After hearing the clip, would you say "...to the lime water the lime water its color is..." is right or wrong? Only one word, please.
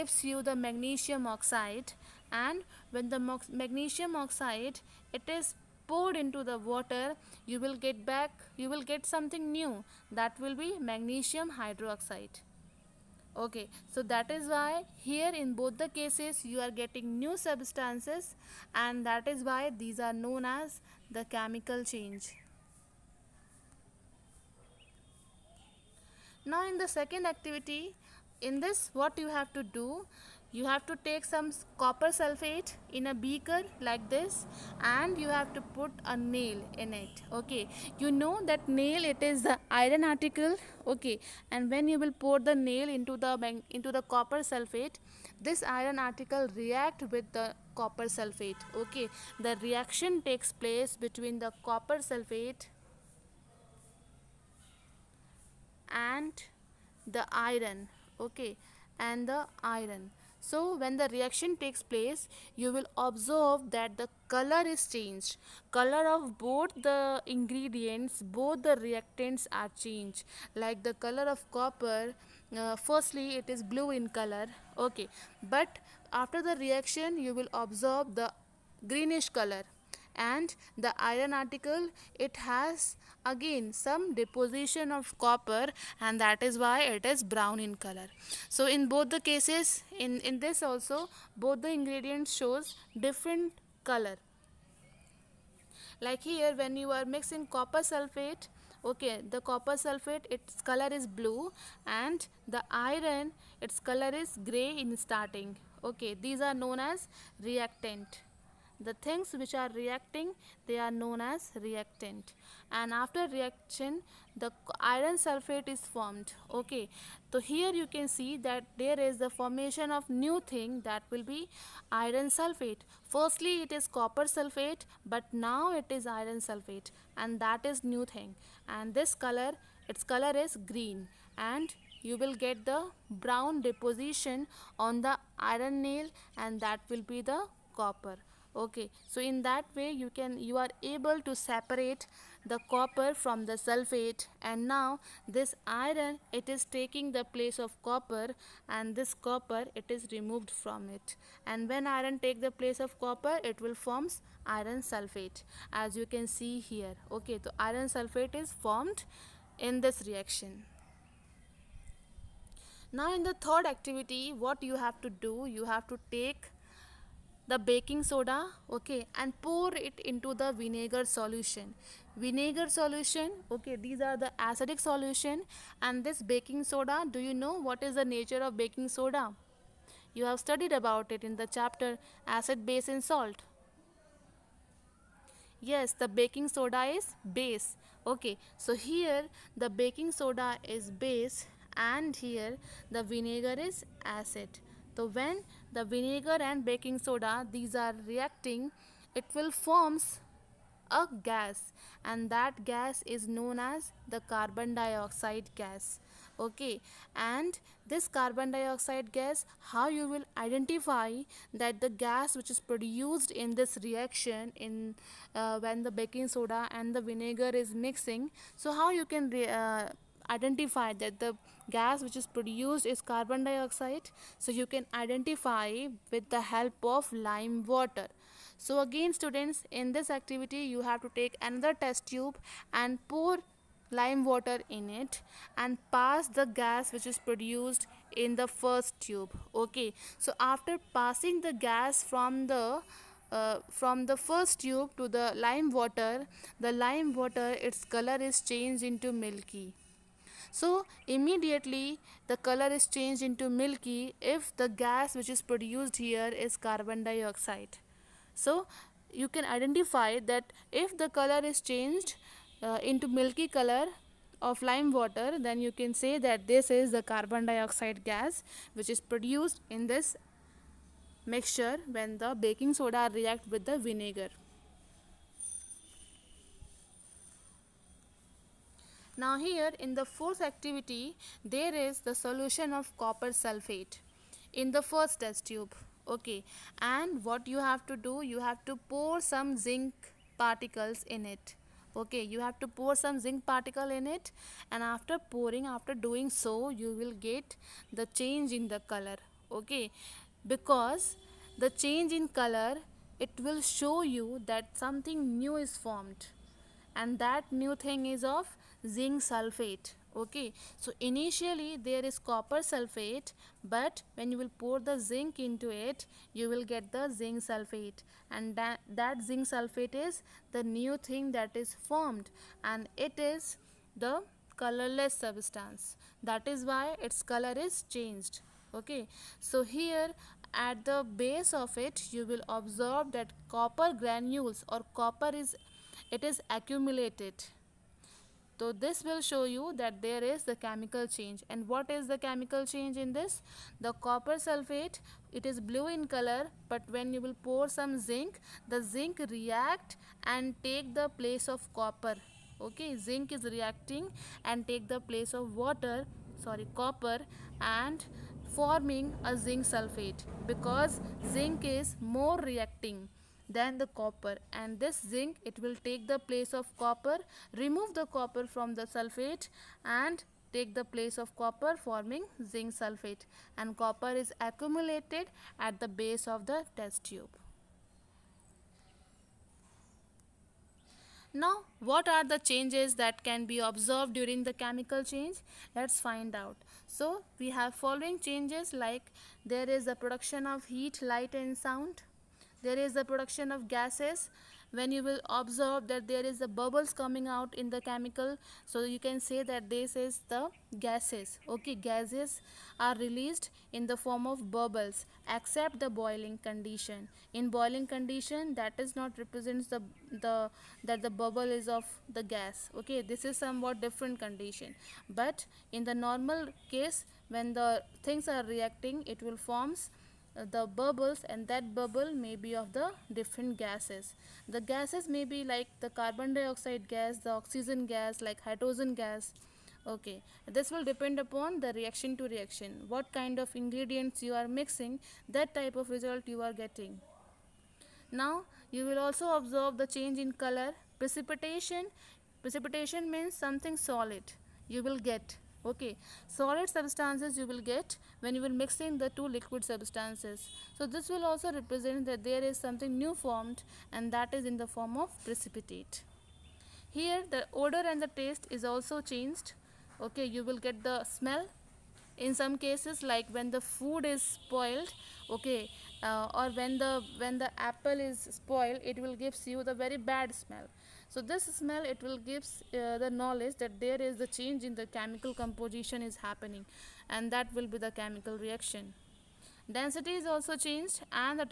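right.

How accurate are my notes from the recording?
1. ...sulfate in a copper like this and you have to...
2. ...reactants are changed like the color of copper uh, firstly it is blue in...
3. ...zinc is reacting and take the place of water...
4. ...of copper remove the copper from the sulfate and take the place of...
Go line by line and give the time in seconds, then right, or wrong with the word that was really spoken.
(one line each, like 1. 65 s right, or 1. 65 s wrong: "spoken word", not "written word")
1. 32 s wrong: "beaker", not "copper"
2. 68 s right
3. 352 s right
4. 366 s right.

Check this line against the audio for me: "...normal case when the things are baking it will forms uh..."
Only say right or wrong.
wrong.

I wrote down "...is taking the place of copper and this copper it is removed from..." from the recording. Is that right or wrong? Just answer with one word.
right.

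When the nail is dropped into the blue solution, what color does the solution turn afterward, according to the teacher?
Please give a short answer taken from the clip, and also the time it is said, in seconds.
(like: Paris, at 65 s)
greenish, at 78 s.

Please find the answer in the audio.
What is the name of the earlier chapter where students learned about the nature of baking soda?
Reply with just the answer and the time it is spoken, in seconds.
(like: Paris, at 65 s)
Acid base and salt, at 182 s.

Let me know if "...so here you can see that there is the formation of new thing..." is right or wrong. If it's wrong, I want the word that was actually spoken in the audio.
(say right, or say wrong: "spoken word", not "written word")
right.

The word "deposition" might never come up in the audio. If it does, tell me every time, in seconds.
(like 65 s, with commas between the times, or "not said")
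84 s, 133 s.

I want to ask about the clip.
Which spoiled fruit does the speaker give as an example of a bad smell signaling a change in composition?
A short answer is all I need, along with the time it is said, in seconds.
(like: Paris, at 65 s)
apple, at 467 s.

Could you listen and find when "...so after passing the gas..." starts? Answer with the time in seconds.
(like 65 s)
240 s.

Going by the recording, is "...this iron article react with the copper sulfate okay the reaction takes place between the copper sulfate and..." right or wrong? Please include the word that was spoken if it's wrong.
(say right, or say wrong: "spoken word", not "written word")
right.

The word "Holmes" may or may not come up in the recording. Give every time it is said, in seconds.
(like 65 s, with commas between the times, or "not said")
not said.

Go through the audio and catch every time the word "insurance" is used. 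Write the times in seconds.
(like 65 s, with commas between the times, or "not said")
not said.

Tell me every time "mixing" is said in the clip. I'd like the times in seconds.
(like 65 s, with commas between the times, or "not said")
97 s, 217 s, 434 s, 448 s.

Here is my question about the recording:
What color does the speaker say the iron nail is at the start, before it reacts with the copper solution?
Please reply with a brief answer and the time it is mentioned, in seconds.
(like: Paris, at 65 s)
gray, at 104 s.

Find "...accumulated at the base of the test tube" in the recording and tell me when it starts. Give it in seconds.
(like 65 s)
374 s.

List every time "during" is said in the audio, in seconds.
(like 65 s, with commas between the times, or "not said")
384 s.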